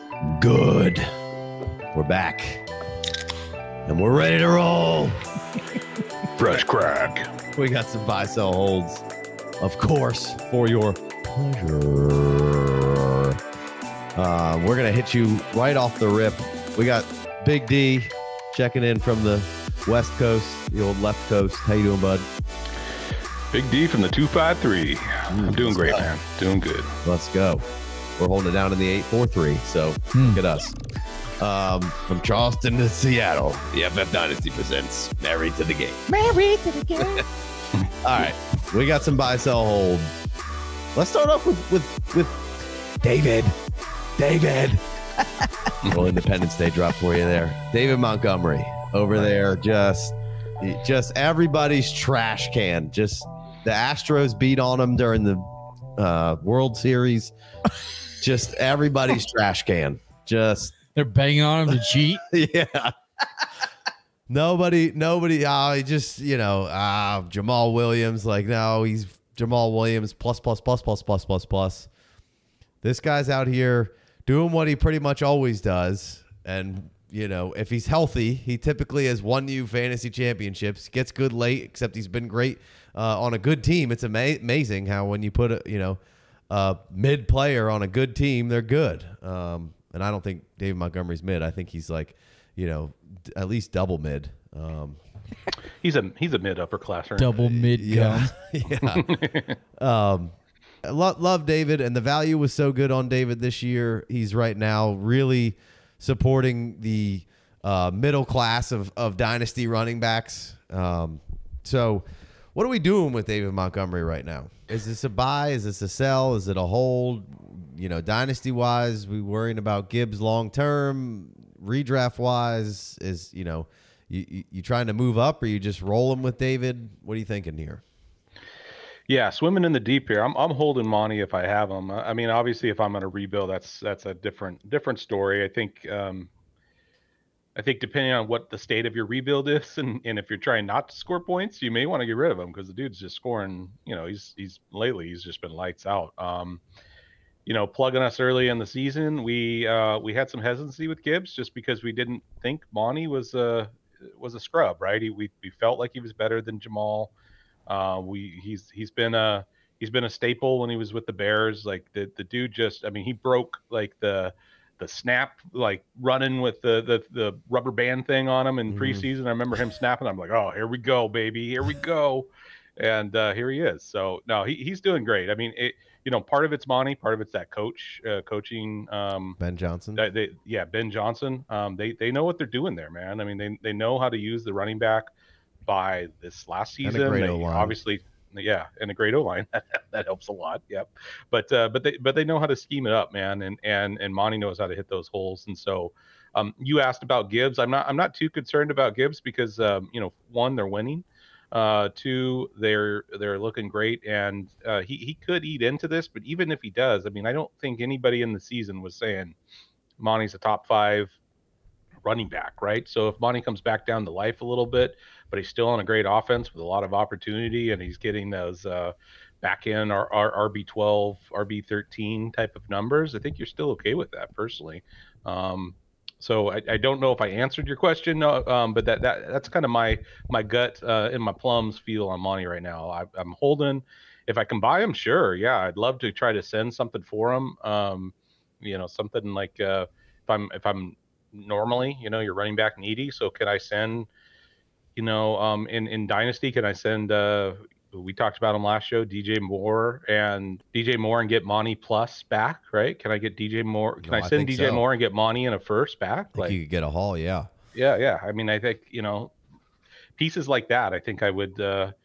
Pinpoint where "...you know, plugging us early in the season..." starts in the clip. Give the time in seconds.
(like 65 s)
147 s.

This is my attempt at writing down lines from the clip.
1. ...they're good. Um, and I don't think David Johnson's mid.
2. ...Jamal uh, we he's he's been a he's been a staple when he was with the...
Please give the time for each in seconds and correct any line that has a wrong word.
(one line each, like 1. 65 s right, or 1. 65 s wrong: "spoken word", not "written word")
1. 88 s wrong: "Montgomery", not "Johnson"
2. 156 s right.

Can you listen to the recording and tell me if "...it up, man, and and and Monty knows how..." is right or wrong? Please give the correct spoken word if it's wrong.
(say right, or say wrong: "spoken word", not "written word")
right.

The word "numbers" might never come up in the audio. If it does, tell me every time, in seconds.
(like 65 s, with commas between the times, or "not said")
222 s.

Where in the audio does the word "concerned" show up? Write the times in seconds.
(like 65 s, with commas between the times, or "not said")
198 s.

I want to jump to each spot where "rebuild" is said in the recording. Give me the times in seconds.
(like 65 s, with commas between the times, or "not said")
133 s, 139 s.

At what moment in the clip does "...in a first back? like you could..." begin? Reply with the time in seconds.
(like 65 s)
255 s.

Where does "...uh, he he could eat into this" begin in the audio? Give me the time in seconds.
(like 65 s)
204 s.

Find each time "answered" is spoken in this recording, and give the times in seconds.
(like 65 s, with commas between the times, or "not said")
227 s.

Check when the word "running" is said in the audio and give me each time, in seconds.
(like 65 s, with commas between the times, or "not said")
109 s, 166 s, 184 s, 212 s, 242 s.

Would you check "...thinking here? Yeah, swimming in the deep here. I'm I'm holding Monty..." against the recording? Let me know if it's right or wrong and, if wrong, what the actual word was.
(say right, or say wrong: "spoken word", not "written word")
right.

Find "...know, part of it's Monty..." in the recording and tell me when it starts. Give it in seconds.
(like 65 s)
176 s.